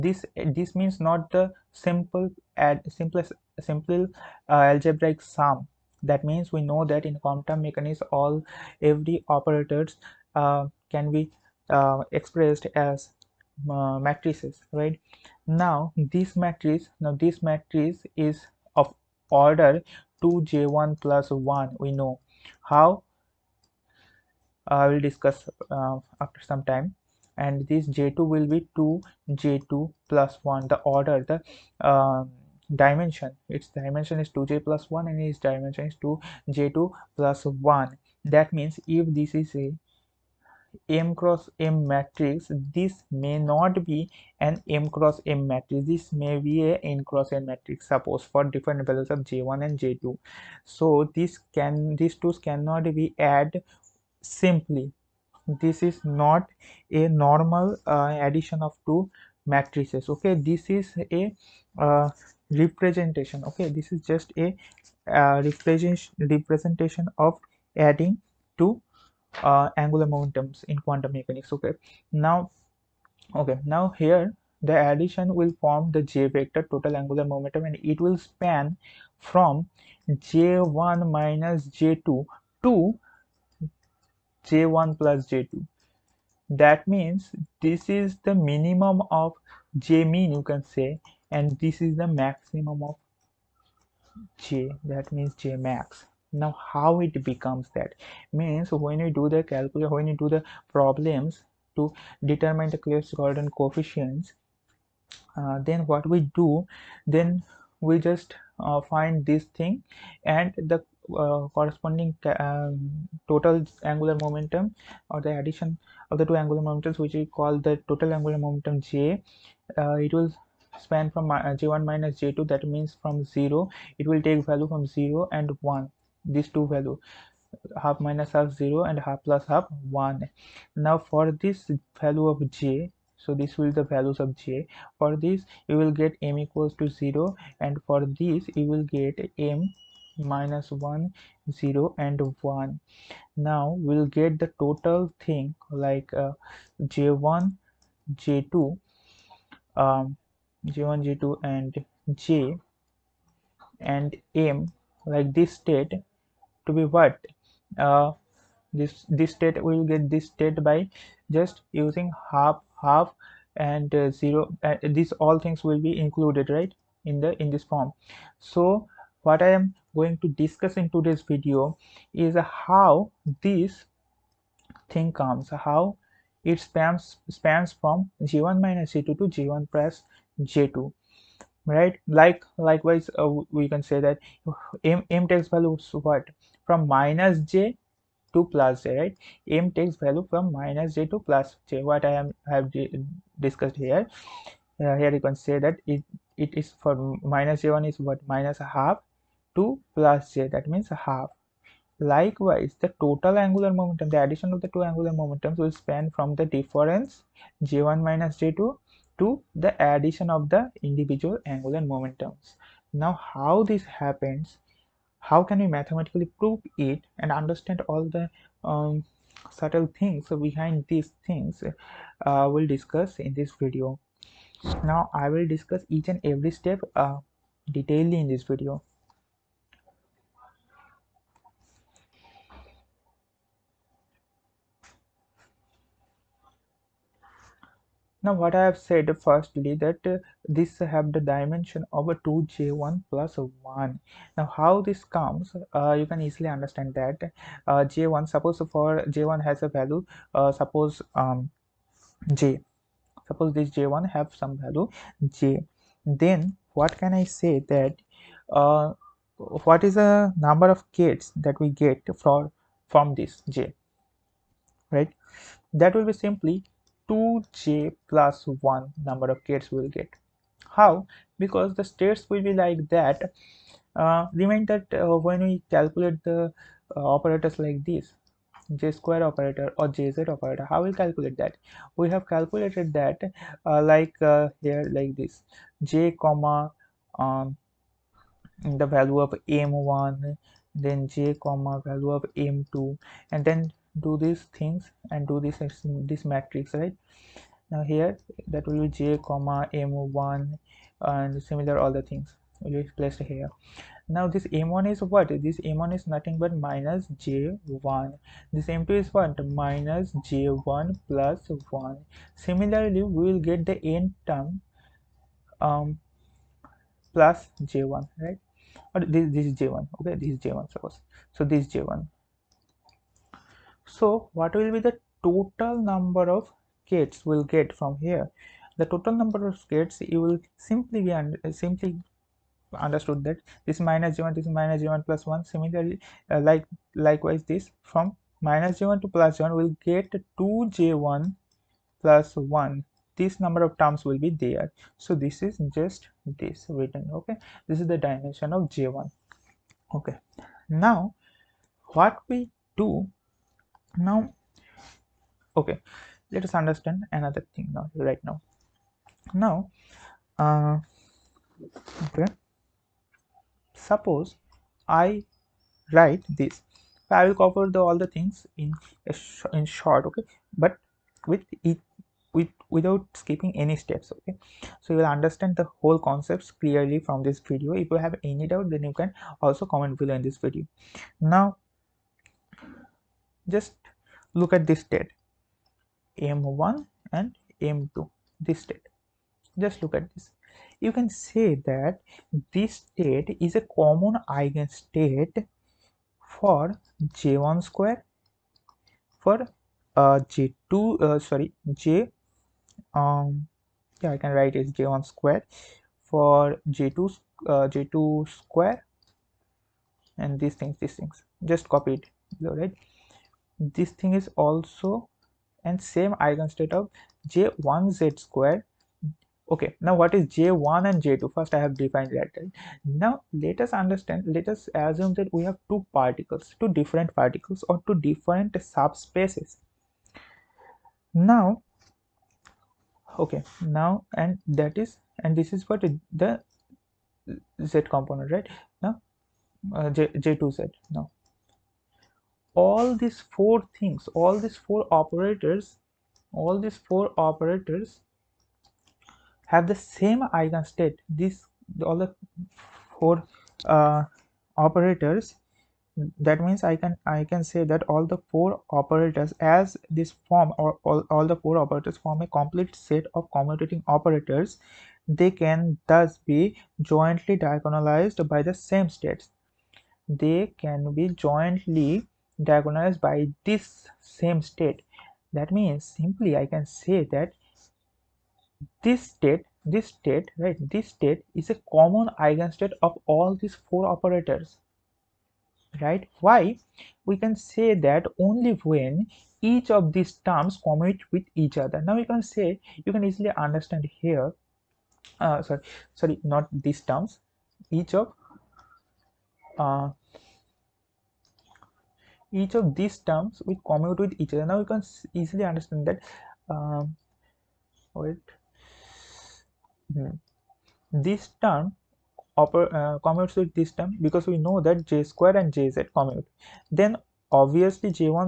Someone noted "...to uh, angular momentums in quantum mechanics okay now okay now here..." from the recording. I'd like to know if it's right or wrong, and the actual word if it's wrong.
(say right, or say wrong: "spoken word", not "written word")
right.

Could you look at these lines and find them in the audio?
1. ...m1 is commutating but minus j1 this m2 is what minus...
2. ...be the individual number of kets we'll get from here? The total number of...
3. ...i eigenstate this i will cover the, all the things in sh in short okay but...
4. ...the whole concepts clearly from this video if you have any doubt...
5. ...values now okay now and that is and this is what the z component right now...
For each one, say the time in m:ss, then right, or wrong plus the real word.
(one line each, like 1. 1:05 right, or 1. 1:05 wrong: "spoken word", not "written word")
1. 5:05 wrong: "nothing", not "commutating"
2. 5:24 wrong: "total", not "individual"
3. 6:04 wrong: "write", not "eigenstate"
4. 6:15 right
5. 7:08 wrong: "subspaces", not "values".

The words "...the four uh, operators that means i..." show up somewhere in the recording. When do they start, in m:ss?
7:31.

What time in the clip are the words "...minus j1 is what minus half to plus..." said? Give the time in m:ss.
3:17.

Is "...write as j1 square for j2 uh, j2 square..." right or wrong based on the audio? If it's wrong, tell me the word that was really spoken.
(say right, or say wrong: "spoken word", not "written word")
right.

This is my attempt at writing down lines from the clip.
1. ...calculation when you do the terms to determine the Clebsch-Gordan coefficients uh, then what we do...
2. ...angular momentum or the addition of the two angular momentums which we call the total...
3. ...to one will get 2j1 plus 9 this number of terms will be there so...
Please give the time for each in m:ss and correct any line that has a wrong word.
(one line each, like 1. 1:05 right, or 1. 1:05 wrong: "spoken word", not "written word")
1. 1:39 wrong: "problems", not "terms"
2. 1:53 right
3. 5:39 wrong: "1", not "9".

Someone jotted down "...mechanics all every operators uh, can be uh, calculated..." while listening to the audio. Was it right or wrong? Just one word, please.
wrong.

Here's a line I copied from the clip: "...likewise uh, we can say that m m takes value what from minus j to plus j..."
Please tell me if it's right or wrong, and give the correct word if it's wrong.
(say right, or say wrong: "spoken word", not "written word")
right.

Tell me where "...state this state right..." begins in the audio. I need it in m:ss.
7:59.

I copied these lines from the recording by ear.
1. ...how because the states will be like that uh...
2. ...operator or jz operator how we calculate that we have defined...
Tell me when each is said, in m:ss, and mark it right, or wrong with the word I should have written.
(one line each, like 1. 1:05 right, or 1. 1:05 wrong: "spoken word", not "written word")
1. 4:30 right
2. 4:39 wrong: "calculated", not "defined".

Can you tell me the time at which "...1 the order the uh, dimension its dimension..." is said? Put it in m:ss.
0:30.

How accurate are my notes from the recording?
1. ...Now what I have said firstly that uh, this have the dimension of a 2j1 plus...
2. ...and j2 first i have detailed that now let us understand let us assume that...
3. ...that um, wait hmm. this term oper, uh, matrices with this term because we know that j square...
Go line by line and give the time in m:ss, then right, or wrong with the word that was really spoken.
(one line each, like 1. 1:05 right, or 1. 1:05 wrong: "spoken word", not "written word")
1. 3:58 right
2. 7:00 wrong: "defined", not "detailed"
3. 8:25 wrong: "commutes", not "matrices".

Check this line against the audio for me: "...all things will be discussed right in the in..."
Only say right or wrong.
wrong.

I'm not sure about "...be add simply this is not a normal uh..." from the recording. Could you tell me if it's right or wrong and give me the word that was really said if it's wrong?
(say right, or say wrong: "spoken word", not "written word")
right.